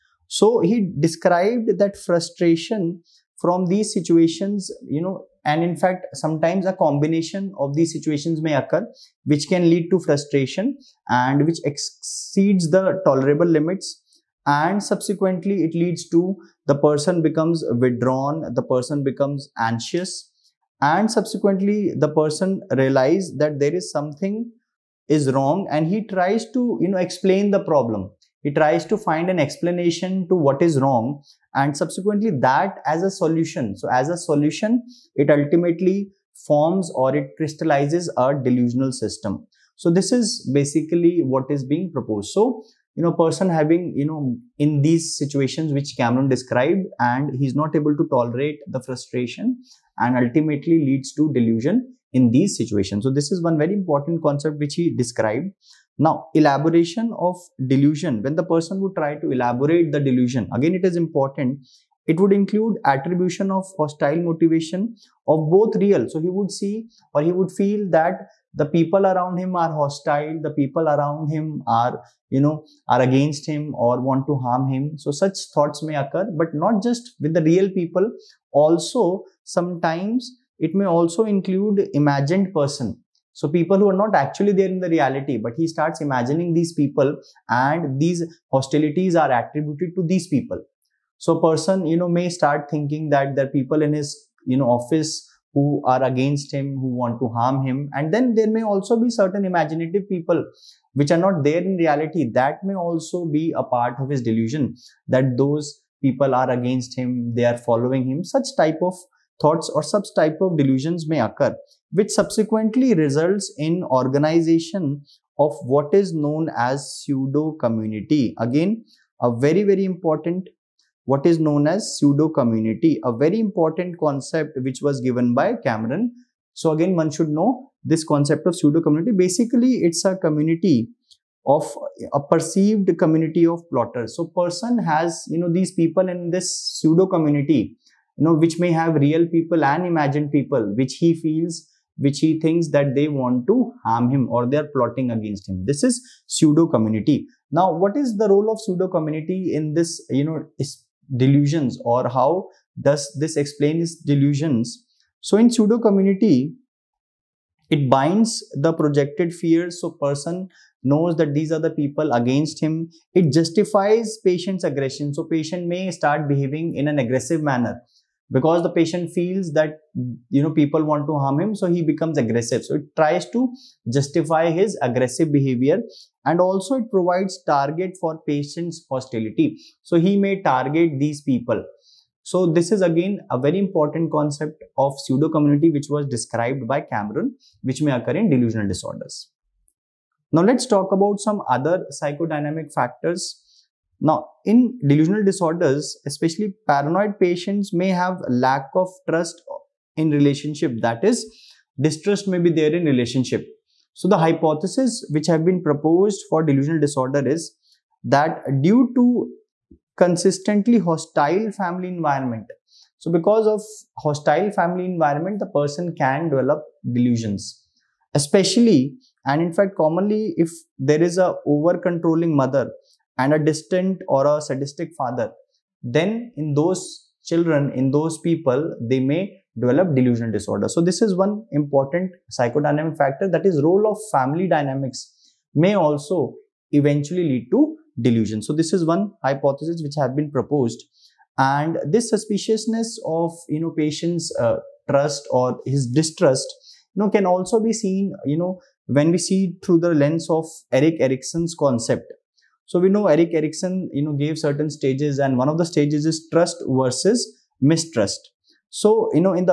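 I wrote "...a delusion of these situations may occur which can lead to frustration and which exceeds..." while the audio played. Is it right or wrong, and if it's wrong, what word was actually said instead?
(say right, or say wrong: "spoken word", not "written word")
wrong: "combination", not "delusion".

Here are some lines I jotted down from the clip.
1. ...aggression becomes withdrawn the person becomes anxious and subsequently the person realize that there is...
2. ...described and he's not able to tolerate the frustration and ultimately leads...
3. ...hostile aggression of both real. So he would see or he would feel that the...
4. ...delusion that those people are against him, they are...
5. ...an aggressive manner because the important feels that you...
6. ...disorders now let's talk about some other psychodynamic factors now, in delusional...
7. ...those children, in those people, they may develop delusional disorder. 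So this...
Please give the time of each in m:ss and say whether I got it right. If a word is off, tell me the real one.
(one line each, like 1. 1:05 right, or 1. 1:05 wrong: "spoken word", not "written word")
1. 0:16 wrong: "person", not "aggression"
2. 0:46 right
3. 1:03 wrong: "motivation", not "aggression"
4. 1:44 right
5. 2:46 wrong: "patient", not "important"
6. 3:08 right
7. 3:46 right.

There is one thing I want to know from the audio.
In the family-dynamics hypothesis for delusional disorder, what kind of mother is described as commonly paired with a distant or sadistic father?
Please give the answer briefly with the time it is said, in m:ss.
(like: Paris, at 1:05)
over controlling mother, at 3:41.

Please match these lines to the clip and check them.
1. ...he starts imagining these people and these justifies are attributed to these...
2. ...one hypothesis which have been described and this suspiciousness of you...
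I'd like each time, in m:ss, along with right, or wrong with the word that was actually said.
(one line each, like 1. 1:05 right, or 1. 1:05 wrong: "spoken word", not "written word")
1. 1:25 wrong: "hostilities", not "justifies"
2. 3:58 wrong: "proposed", not "described".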